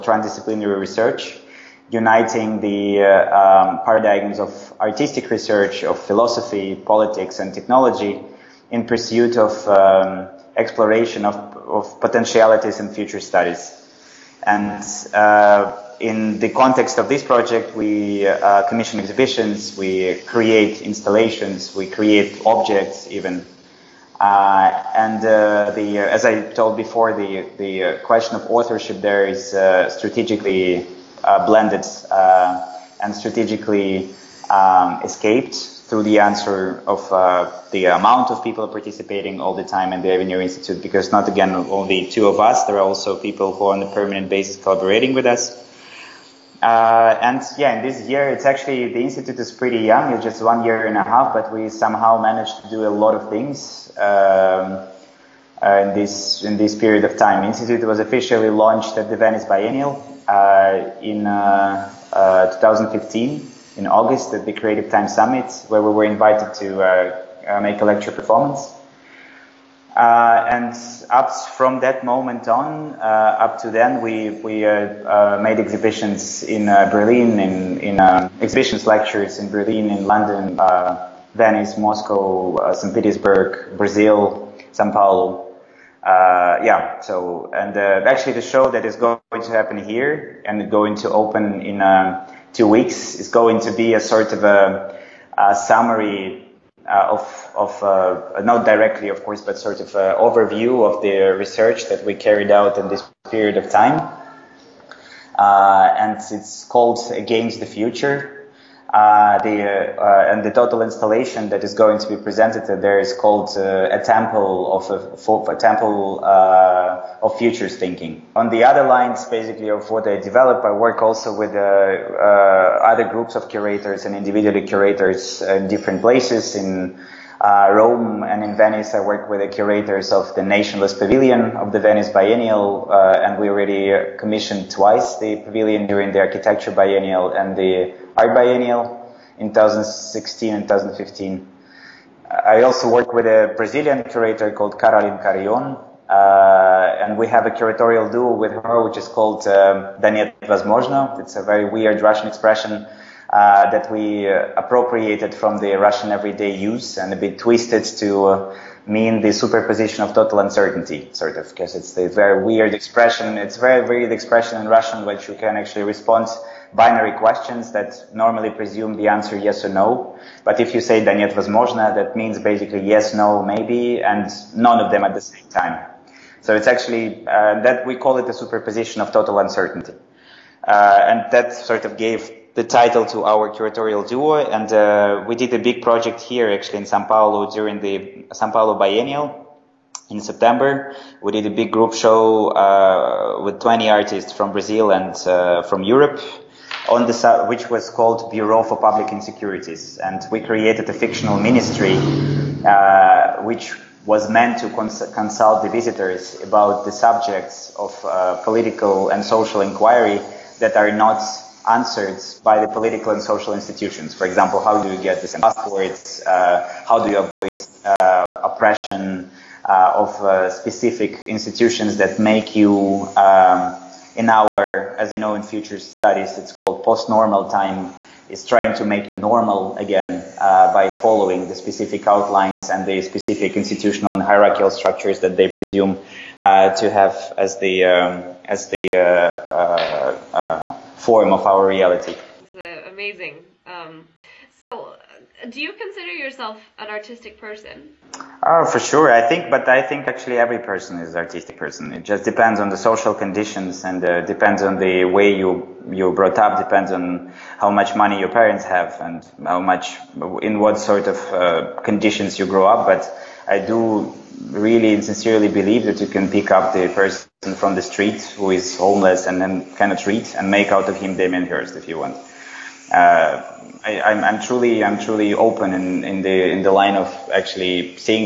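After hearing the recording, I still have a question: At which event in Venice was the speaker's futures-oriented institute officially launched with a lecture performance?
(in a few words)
Creative Time Summit.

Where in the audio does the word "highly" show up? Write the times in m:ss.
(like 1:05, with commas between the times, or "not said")
not said.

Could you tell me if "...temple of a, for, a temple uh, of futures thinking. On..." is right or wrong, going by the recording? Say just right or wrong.
right.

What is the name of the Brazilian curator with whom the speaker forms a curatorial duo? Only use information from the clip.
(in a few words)
Caroline Carion.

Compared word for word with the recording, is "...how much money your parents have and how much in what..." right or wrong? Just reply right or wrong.
right.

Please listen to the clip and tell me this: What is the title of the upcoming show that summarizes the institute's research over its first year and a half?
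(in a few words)
Against the Future.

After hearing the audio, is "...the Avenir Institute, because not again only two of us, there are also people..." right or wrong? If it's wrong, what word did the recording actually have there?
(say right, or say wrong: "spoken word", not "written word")
right.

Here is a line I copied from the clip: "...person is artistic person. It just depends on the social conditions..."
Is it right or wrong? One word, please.
right.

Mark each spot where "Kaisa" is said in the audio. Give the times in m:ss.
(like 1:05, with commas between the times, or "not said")
not said.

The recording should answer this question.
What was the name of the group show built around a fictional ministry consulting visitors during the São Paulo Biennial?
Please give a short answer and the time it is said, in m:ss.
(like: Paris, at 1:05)
Bureau for Public Insecurities, at 3:18.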